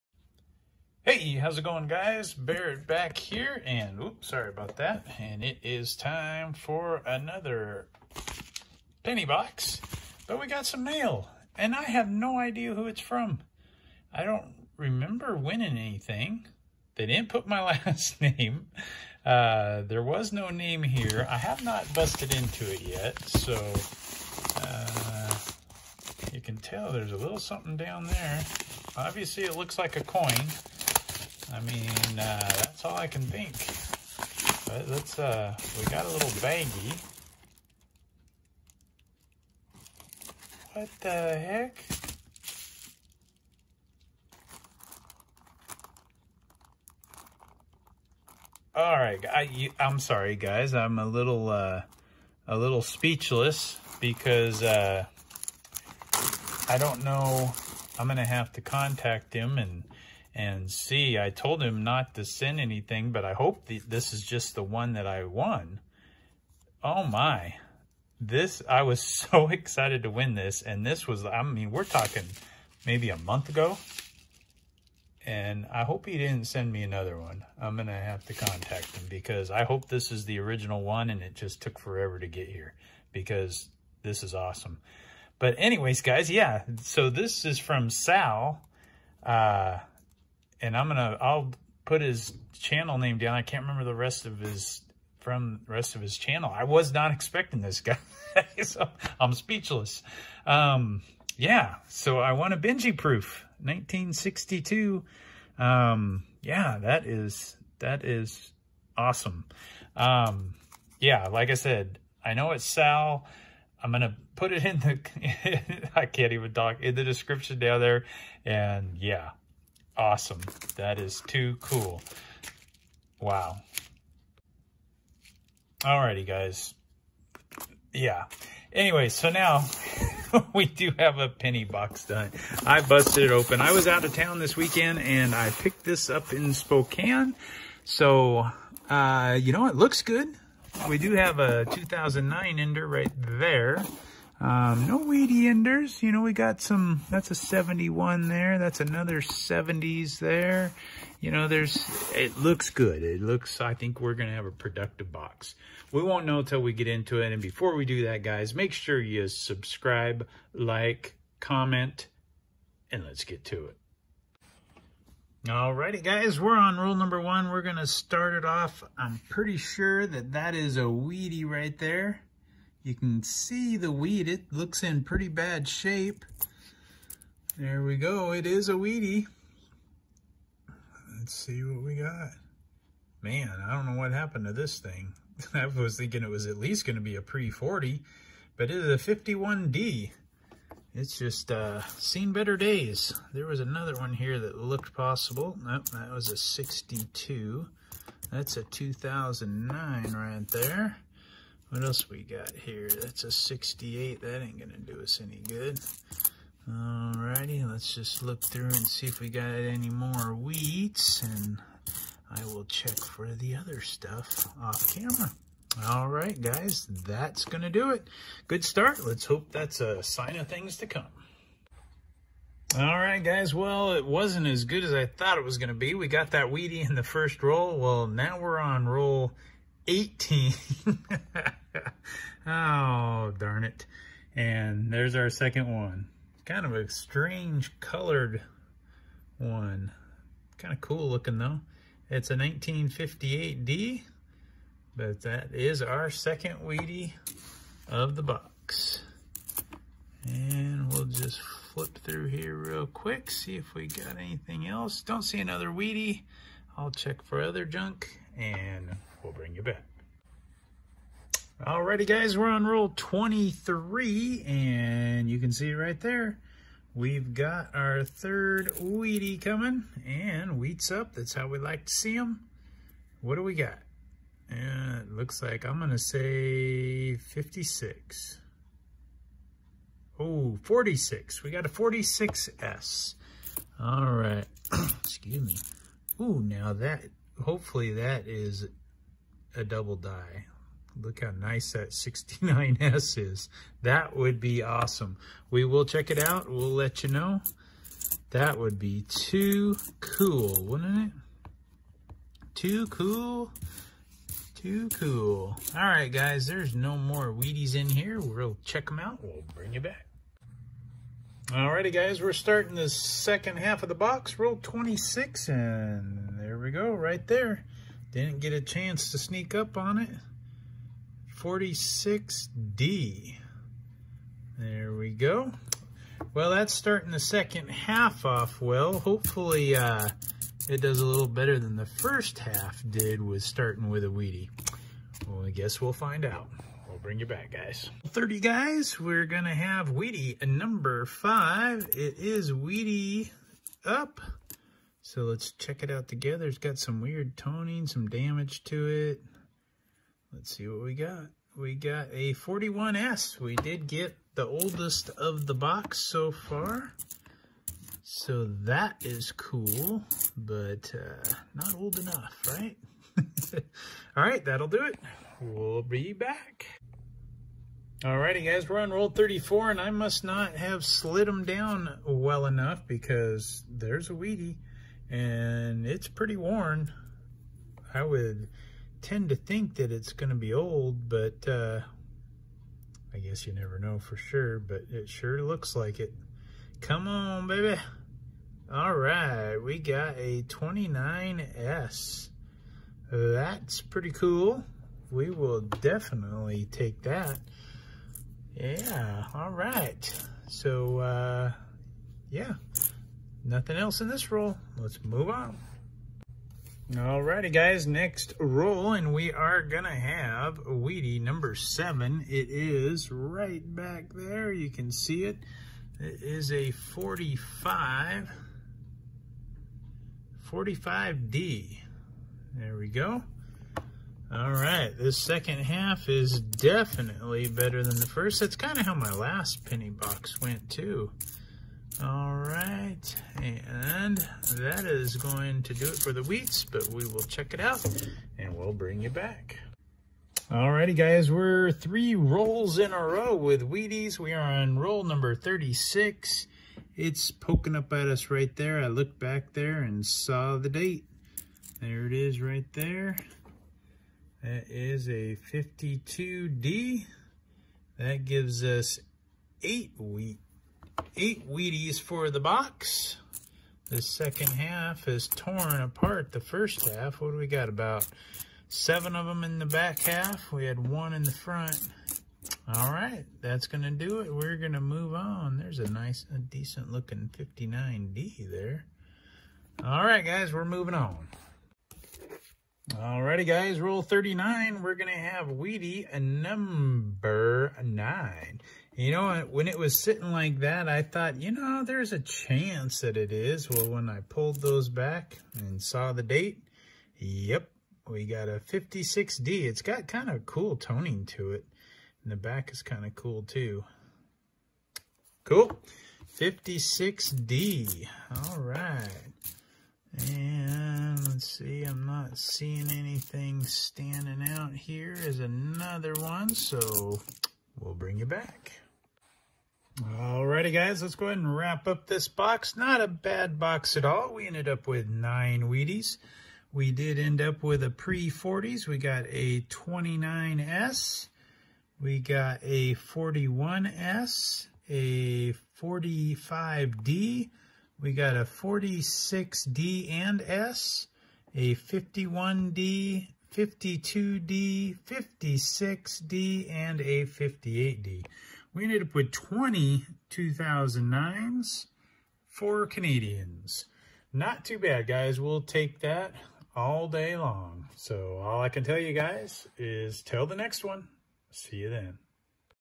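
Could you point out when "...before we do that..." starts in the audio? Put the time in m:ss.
2:37.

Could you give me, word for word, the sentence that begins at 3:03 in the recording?
Man, I don't know what happened to this thing.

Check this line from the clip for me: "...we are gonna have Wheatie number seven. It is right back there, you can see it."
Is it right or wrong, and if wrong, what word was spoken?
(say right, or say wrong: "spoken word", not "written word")
right.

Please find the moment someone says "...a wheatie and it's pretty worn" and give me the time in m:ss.
6:14.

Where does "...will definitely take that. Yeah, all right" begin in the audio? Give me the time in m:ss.
6:35.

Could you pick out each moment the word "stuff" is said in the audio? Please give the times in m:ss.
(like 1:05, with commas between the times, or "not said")
3:33.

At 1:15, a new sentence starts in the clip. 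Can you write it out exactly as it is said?
And I hope he didn't send me another one.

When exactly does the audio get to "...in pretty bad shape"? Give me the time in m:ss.
2:54.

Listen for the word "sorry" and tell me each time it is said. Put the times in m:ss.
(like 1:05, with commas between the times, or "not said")
0:04, 0:49.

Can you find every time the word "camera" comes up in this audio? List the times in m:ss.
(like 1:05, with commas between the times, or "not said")
3:34.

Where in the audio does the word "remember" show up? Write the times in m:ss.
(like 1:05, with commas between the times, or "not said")
0:14, 1:33.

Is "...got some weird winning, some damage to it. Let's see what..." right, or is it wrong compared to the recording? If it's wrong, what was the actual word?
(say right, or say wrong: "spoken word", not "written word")
wrong: "toning", not "winning".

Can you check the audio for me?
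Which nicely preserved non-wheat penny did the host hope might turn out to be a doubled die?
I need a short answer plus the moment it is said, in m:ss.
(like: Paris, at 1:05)
69S, at 4:51.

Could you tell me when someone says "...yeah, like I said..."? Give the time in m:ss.
1:50.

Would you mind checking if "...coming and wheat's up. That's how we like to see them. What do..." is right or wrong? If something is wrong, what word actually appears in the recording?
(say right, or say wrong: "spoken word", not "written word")
right.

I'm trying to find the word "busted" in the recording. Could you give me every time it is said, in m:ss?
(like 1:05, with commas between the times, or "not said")
0:21, 2:12.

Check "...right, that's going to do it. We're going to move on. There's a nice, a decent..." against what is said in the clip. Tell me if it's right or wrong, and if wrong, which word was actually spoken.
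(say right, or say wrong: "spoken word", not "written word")
right.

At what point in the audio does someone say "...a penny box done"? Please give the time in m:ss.
2:11.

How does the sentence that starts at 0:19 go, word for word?
Uh, there was no name here.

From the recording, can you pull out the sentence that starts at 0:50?
I'm a little, uh, a little speechless because uh, I don't know.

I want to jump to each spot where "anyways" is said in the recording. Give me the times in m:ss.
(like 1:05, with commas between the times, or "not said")
1:25, 2:08.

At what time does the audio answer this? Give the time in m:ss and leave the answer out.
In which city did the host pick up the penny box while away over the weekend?
2:16.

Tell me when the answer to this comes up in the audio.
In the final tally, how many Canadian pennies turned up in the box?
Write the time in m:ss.
9:12.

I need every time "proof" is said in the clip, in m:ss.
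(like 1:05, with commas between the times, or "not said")
1:42.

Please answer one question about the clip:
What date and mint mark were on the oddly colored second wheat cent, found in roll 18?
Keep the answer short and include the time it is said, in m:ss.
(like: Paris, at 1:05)
1958D, at 4:02.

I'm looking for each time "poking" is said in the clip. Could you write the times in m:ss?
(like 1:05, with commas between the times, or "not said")
7:27.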